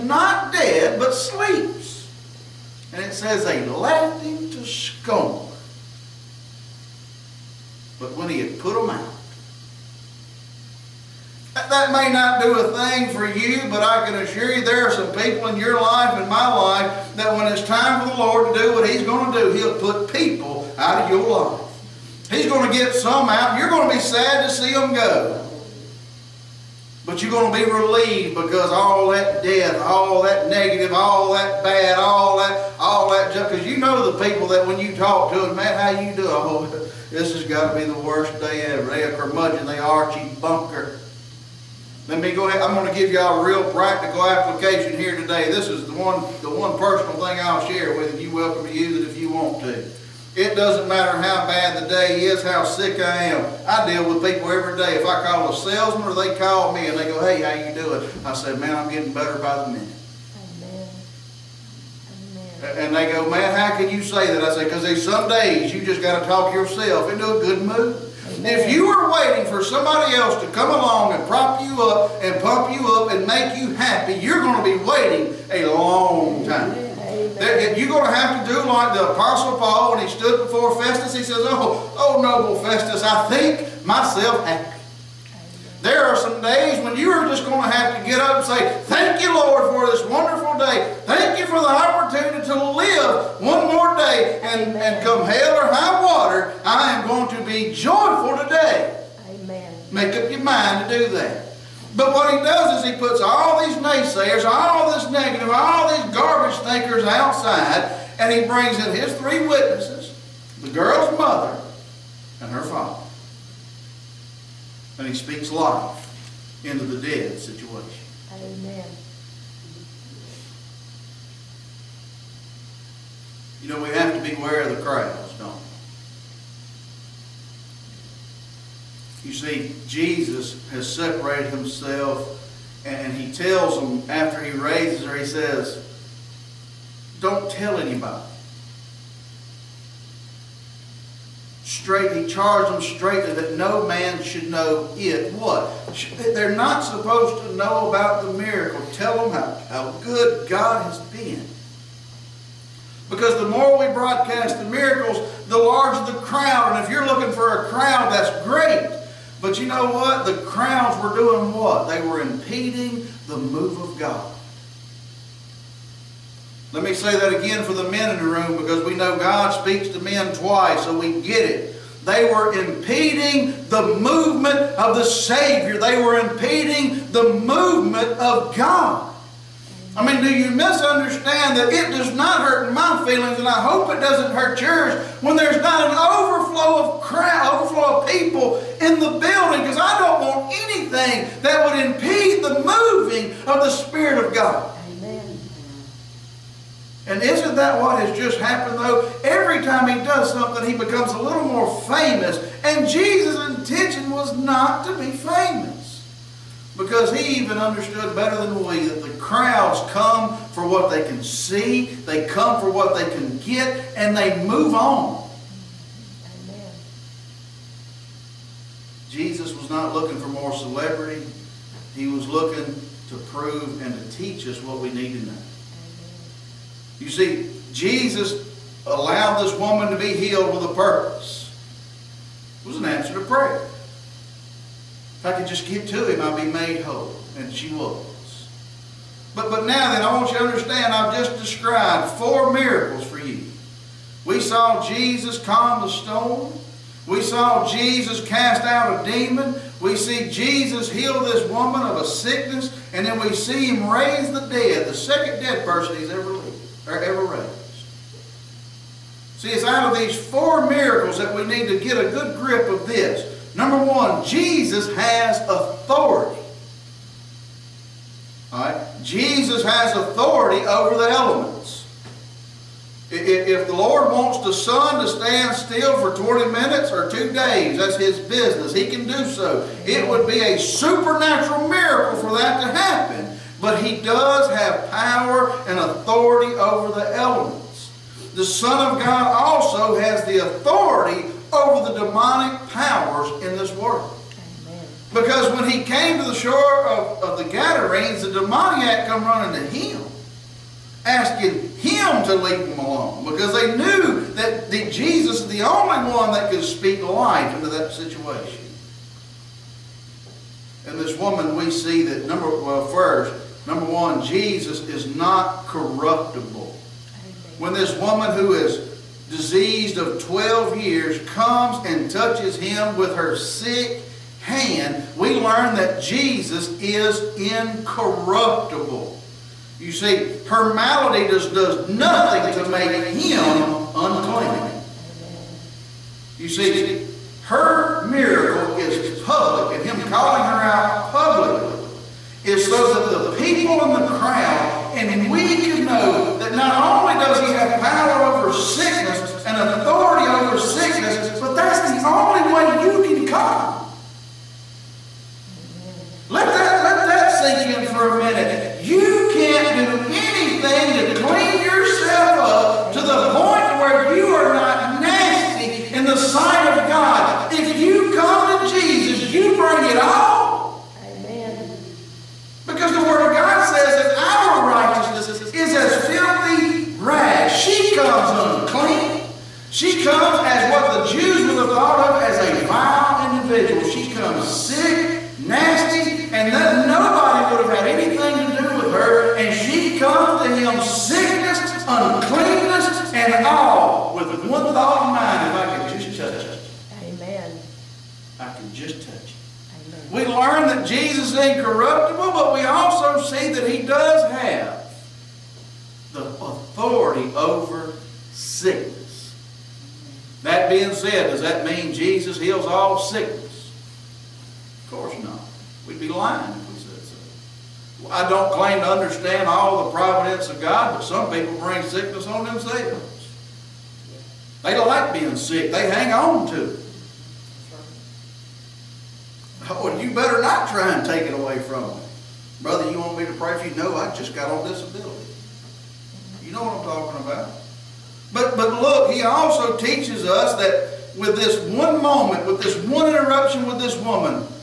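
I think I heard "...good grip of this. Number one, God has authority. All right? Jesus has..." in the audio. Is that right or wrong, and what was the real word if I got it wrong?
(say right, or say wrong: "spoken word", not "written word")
wrong: "Jesus", not "God".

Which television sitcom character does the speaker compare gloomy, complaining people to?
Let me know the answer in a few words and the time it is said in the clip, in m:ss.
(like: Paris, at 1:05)
Archie Bunker, at 0:40.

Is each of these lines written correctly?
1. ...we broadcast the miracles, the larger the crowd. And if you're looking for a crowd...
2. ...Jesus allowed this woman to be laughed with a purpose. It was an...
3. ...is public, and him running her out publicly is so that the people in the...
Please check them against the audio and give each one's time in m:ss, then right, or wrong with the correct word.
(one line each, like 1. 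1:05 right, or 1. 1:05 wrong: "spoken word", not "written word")
1. 2:33 right
2. 3:47 wrong: "healed", not "laughed"
3. 5:38 wrong: "calling", not "running".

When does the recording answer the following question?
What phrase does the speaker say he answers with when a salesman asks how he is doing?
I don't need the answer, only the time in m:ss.
0:58.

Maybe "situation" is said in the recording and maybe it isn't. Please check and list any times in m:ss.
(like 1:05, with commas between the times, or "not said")
1:57, 5:07.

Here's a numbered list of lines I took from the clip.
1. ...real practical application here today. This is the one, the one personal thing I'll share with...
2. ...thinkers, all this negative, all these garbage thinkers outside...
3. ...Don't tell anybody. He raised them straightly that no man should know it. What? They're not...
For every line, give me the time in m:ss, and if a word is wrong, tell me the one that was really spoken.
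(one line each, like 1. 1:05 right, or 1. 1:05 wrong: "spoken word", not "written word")
1. 0:43 right
2. 1:43 wrong: "naysayers", not "thinkers"
3. 2:17 wrong: "charged", not "raised".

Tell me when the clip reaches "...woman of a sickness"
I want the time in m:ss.
4:11.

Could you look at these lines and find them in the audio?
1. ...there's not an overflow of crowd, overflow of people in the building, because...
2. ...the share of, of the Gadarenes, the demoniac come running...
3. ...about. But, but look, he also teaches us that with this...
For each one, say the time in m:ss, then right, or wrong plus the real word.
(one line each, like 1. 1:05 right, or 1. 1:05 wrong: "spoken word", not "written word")
1. 3:05 right
2. 4:56 wrong: "shore", not "share"
3. 7:17 right.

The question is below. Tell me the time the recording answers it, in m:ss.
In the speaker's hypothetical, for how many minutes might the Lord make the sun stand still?
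4:36.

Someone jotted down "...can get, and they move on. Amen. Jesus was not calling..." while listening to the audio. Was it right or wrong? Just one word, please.
wrong.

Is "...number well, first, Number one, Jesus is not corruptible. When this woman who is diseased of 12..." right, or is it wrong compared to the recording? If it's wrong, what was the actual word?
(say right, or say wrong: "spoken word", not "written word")
right.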